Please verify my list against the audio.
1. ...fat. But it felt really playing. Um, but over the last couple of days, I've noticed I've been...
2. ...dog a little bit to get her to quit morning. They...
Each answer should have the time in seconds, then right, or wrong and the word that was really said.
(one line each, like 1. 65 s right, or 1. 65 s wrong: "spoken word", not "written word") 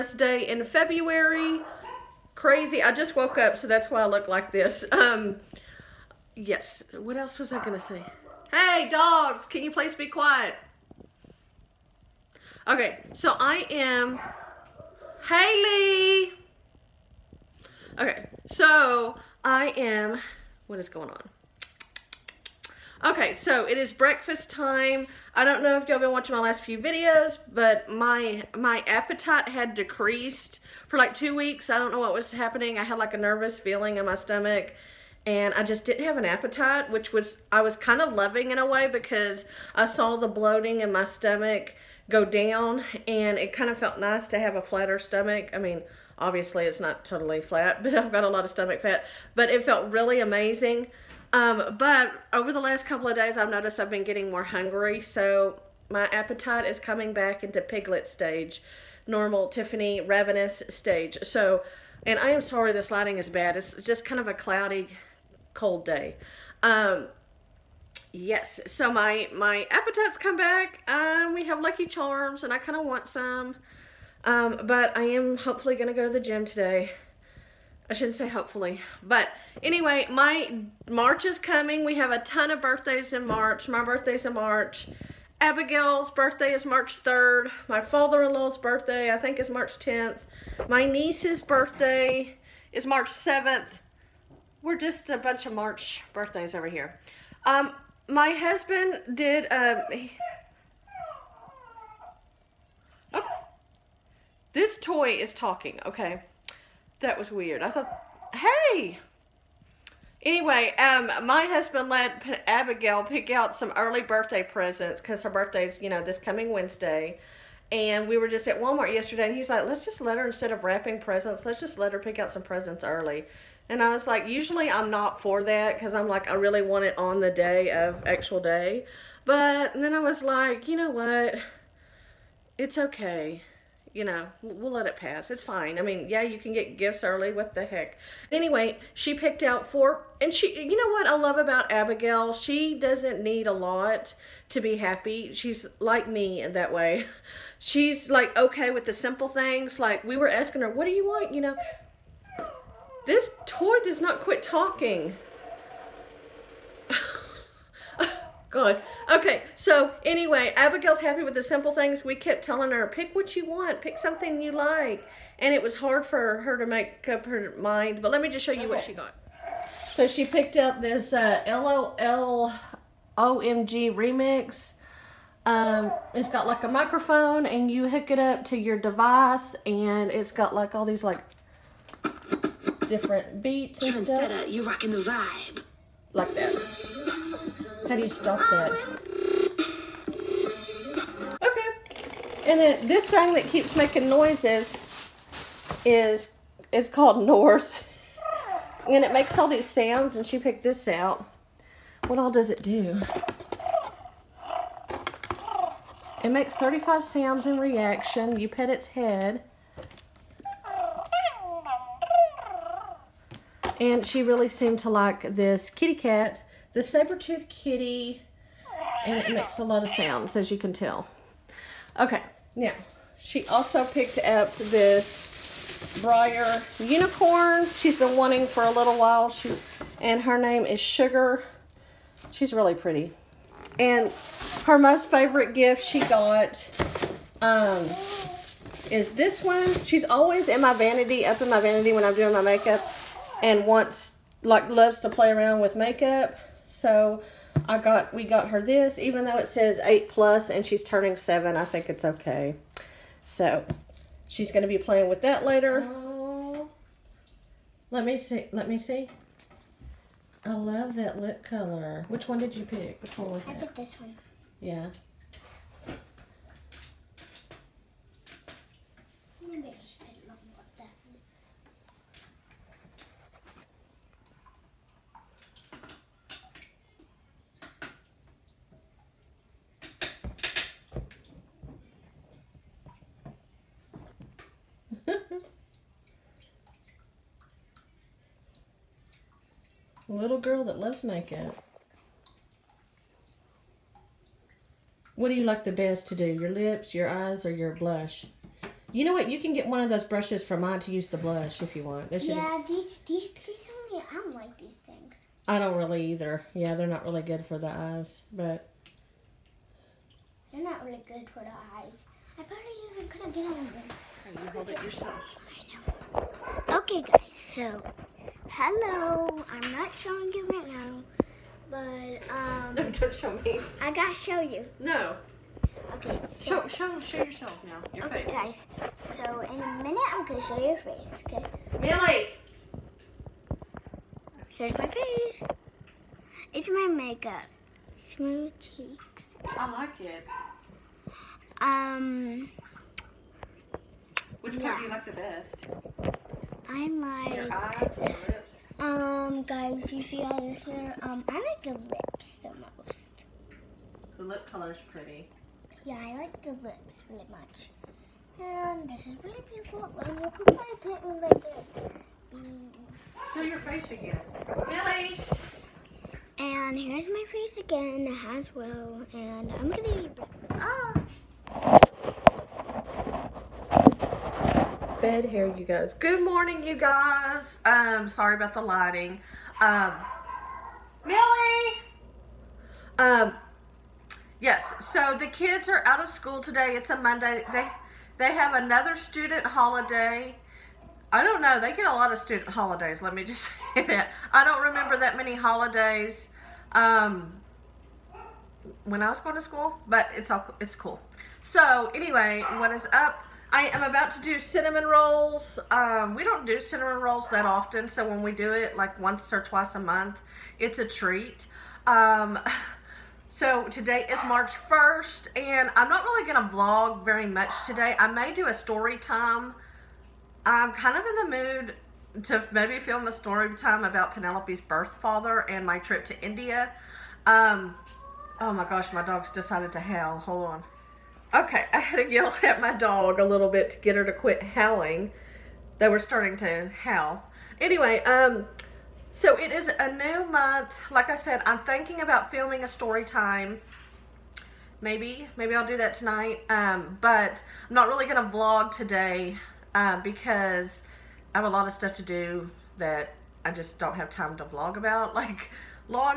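1. 48 s wrong: "amazing", not "playing"
2. 432 s wrong: "howling", not "morning".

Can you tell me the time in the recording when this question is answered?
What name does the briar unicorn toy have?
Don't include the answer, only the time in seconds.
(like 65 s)
230 s.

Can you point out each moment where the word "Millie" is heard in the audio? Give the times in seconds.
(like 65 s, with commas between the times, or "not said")
331 s, 381 s.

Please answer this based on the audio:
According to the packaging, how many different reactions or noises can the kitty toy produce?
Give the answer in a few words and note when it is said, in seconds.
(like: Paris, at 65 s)
35, at 206 s.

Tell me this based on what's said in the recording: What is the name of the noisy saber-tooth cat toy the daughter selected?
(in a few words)
North.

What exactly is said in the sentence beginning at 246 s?
So I got we got her this, even though it says eight plus and she's turning seven, I think it's okay.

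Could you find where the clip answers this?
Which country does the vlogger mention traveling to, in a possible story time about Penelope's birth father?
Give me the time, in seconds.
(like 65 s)
426 s.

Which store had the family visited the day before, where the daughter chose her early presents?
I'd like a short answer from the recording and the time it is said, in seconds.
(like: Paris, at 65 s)
Walmart, at 118 s.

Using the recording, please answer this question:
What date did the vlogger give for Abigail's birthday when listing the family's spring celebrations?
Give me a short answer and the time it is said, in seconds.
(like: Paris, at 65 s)
March 3rd, at 86 s.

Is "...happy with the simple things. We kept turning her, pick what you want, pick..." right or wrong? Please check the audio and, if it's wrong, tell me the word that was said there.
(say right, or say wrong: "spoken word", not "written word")
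wrong: "telling", not "turning".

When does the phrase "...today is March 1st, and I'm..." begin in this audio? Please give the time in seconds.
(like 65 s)
413 s.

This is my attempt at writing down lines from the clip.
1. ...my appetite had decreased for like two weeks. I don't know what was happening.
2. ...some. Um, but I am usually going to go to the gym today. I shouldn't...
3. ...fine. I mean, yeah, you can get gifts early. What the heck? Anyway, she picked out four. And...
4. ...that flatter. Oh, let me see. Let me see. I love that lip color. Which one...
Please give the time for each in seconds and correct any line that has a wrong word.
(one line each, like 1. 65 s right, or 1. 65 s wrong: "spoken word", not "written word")
1. 28 s right
2. 73 s wrong: "hopefully", not "usually"
3. 135 s right
4. 255 s wrong: "later", not "flatter".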